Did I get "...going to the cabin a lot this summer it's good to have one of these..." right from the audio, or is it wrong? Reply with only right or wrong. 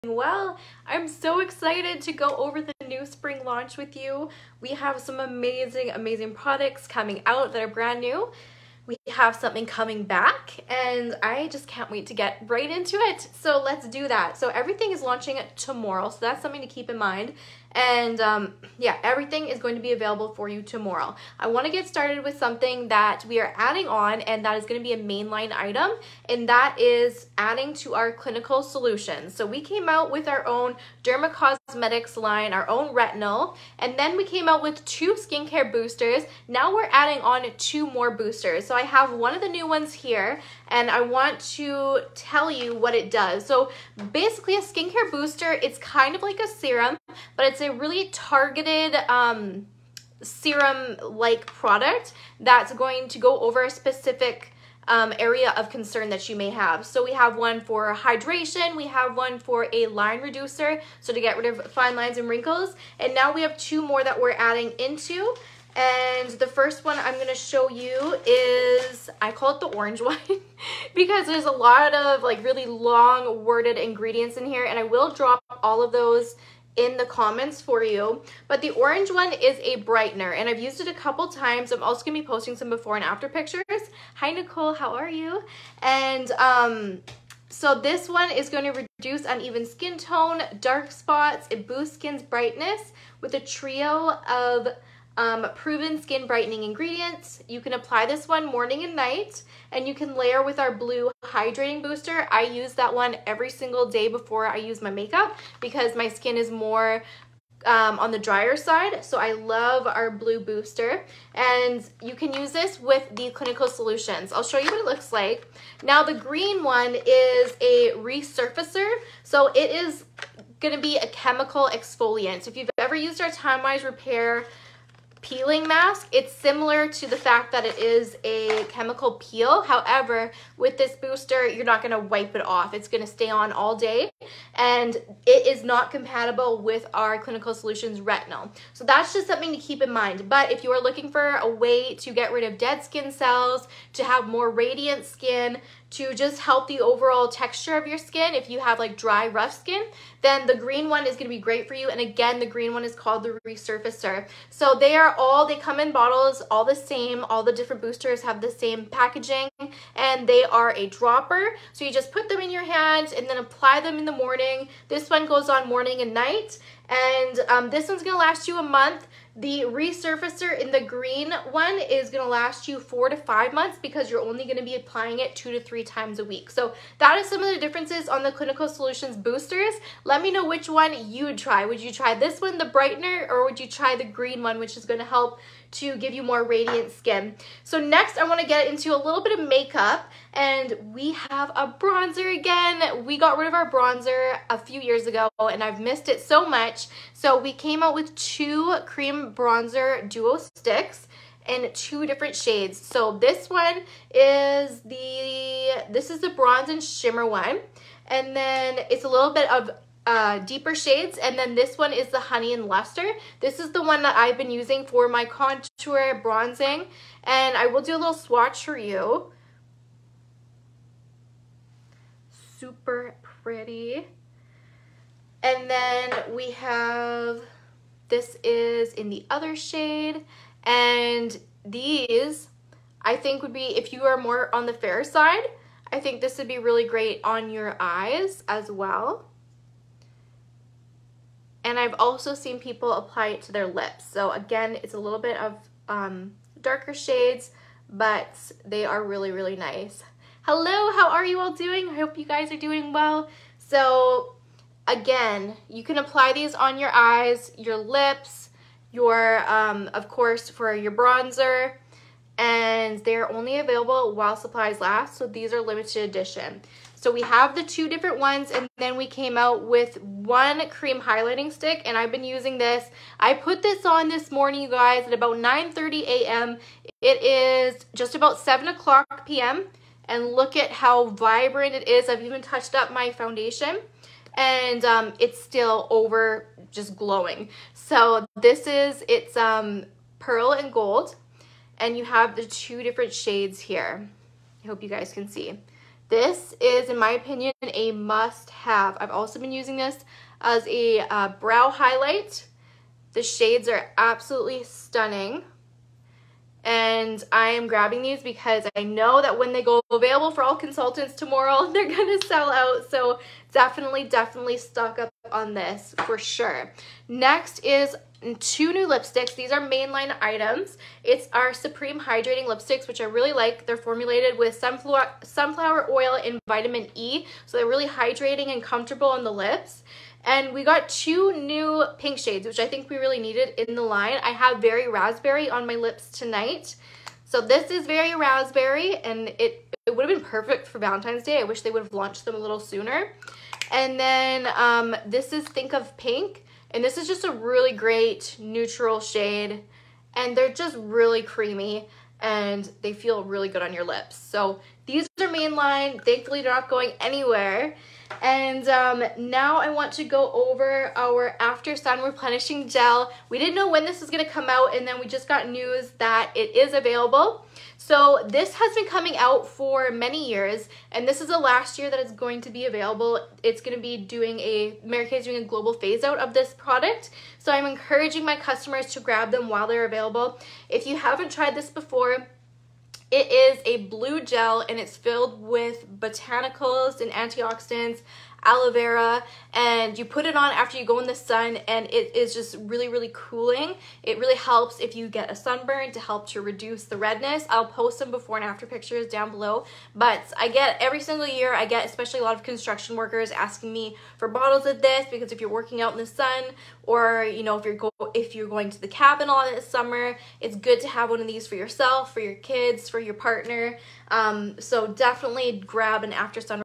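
right.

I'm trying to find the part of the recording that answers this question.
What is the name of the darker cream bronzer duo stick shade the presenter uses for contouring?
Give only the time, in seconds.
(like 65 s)
212 s.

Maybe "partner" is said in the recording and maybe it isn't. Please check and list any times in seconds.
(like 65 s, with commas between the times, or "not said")
413 s.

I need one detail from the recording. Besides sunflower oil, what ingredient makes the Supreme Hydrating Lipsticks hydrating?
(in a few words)
Vitamin E.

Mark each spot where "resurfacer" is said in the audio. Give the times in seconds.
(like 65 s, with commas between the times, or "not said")
117 s, 153 s, 169 s.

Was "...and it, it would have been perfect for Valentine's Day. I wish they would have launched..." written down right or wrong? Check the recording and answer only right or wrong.
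right.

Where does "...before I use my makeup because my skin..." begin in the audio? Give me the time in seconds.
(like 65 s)
104 s.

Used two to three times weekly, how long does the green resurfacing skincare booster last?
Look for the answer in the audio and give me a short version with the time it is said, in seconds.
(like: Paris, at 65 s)
4 to 5 months, at 172 s.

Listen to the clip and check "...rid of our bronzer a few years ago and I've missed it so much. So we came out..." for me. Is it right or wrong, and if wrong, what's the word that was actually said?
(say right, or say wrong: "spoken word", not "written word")
right.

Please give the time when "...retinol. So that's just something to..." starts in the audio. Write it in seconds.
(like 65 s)
137 s.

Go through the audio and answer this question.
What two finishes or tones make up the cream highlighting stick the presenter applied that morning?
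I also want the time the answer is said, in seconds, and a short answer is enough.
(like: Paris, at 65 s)
Pearl and gold, at 290 s.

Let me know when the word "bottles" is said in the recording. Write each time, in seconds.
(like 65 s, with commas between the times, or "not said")
155 s, 404 s.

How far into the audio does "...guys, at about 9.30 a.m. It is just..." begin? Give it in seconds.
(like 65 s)
274 s.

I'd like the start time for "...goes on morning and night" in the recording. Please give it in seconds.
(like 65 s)
165 s.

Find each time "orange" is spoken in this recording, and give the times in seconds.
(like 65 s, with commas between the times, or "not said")
69 s, 78 s.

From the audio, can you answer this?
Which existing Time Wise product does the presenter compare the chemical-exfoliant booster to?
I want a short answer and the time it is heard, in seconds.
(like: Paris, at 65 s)
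Repair peeling mask, at 123 s.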